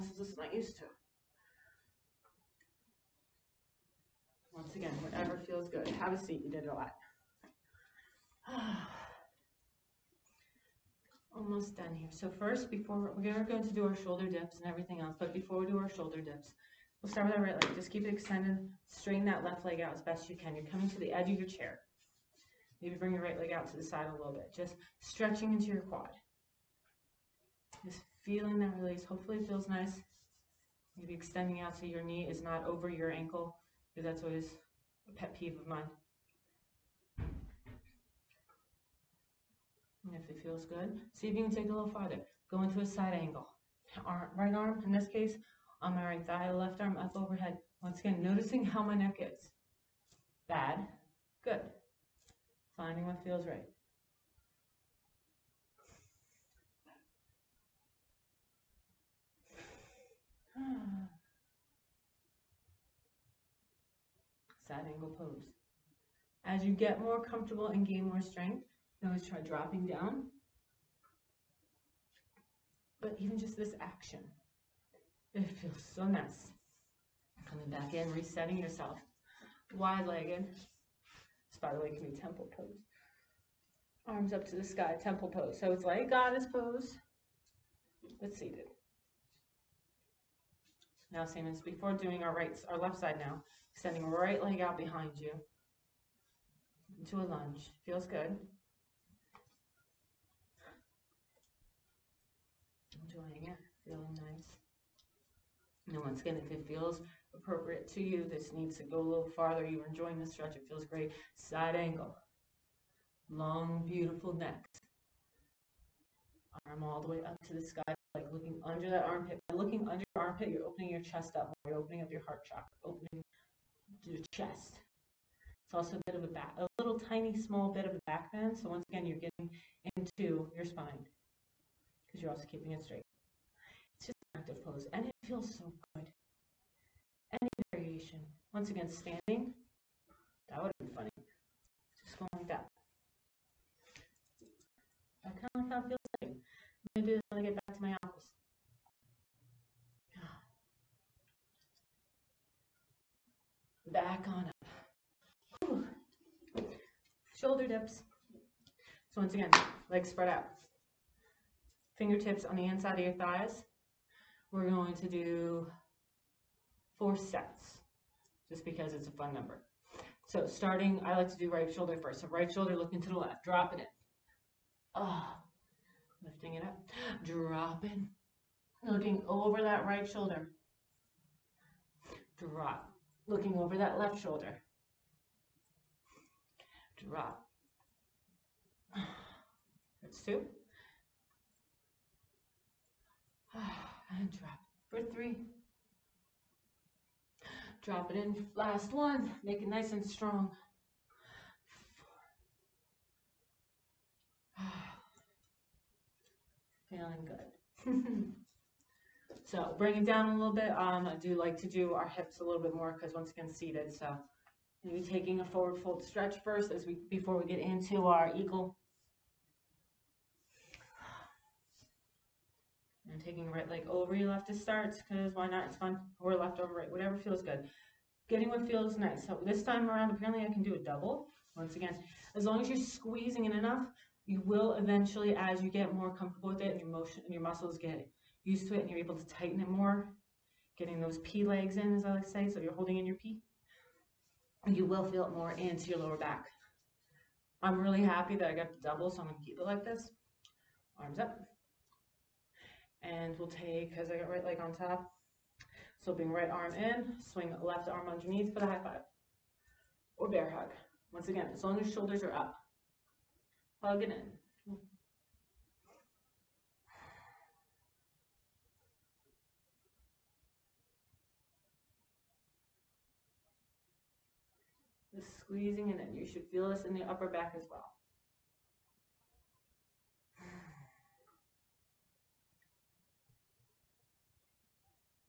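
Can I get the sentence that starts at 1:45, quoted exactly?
And once again, if it feels appropriate to you, this needs to go a little farther.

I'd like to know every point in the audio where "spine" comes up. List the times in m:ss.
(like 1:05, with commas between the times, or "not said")
2:10.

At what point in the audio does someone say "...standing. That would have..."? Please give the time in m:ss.
2:18.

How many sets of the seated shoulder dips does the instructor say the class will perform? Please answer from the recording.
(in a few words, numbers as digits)
4.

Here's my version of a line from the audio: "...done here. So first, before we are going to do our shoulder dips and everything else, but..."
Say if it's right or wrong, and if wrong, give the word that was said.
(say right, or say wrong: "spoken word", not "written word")
right.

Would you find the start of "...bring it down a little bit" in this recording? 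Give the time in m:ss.
3:29.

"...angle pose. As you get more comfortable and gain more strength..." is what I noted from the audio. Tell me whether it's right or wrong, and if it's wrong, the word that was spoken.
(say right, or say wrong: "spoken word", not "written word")
right.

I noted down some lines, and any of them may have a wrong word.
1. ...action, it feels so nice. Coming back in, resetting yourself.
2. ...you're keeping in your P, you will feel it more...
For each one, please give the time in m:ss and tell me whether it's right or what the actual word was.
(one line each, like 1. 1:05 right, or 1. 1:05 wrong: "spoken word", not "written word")
1. 1:13 right
2. 4:02 wrong: "holding", not "keeping".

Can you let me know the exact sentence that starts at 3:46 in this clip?
Or left over right, whatever feels good.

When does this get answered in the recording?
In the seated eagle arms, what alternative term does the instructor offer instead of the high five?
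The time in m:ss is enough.
4:20.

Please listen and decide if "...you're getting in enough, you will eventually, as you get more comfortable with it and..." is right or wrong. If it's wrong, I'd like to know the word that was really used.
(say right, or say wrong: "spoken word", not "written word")
wrong: "squeezing", not "getting".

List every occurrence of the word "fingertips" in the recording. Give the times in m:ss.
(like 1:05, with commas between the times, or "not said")
2:41.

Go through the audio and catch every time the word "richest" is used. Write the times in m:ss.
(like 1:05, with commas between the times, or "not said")
not said.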